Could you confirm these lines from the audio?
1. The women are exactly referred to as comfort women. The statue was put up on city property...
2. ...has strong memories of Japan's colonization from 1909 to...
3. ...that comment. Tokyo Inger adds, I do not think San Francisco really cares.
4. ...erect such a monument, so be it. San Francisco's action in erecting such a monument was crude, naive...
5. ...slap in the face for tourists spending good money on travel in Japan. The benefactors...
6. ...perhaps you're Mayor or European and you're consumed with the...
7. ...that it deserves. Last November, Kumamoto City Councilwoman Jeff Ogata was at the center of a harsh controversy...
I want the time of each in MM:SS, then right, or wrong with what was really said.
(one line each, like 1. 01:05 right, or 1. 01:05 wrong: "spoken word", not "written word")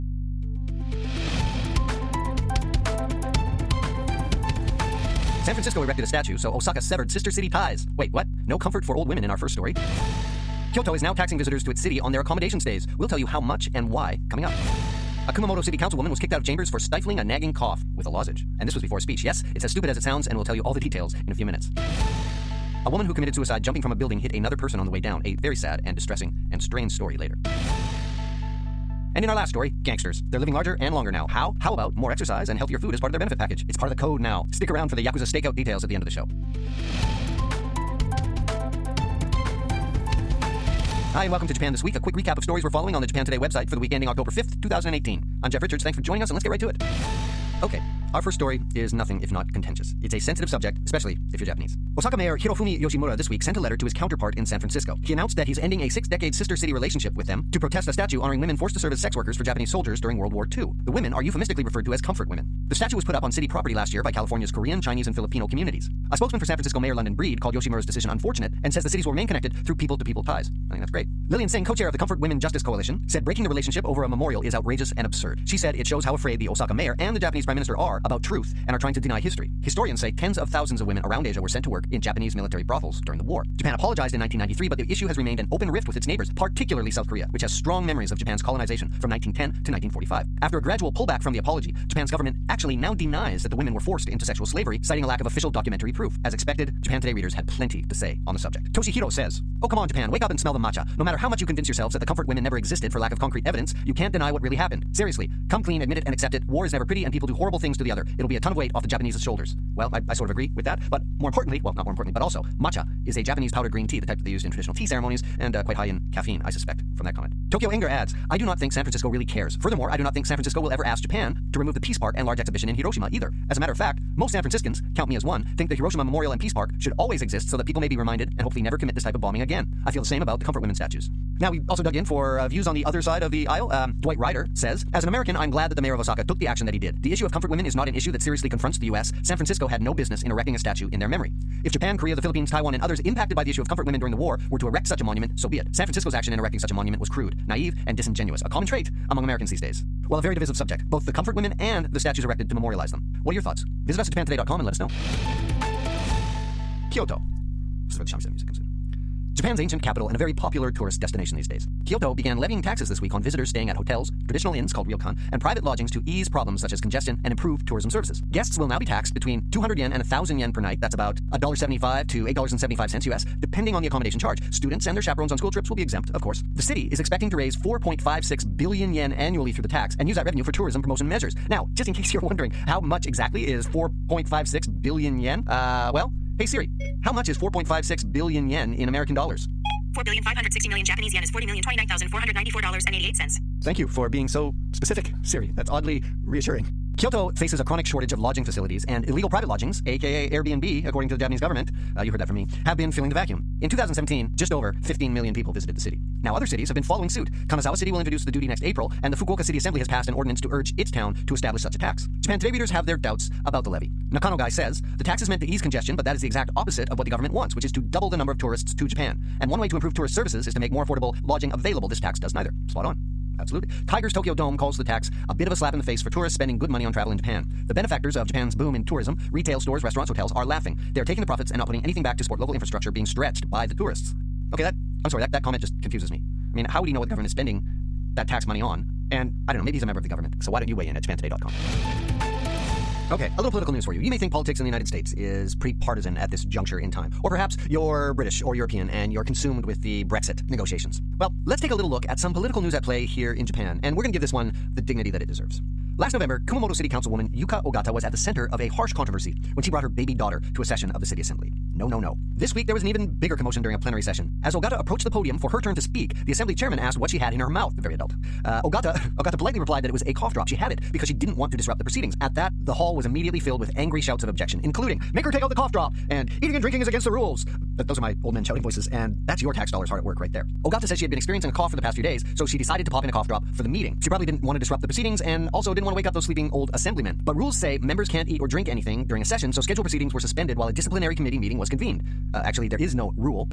1. 01:00 wrong: "euphemistically", not "exactly"
2. 01:27 wrong: "1910", not "1909"
3. 01:57 right
4. 02:24 right
5. 03:45 right
6. 04:07 wrong: "British", not "Mayor"
7. 04:15 wrong: "Yuka", not "Jeff".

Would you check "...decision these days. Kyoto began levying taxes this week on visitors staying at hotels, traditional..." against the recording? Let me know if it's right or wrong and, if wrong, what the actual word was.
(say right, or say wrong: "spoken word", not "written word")
wrong: "destination", not "decision".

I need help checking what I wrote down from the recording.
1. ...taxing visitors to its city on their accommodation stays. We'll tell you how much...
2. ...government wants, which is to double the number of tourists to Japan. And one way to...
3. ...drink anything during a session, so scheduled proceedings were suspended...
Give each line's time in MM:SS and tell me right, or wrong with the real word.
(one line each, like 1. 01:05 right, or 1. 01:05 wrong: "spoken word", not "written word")
1. 00:11 right
2. 03:37 right
3. 04:48 right.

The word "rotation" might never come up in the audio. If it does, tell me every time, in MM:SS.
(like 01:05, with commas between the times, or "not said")
not said.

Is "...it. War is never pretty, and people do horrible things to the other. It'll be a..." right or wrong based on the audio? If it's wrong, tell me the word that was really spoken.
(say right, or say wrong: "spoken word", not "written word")
right.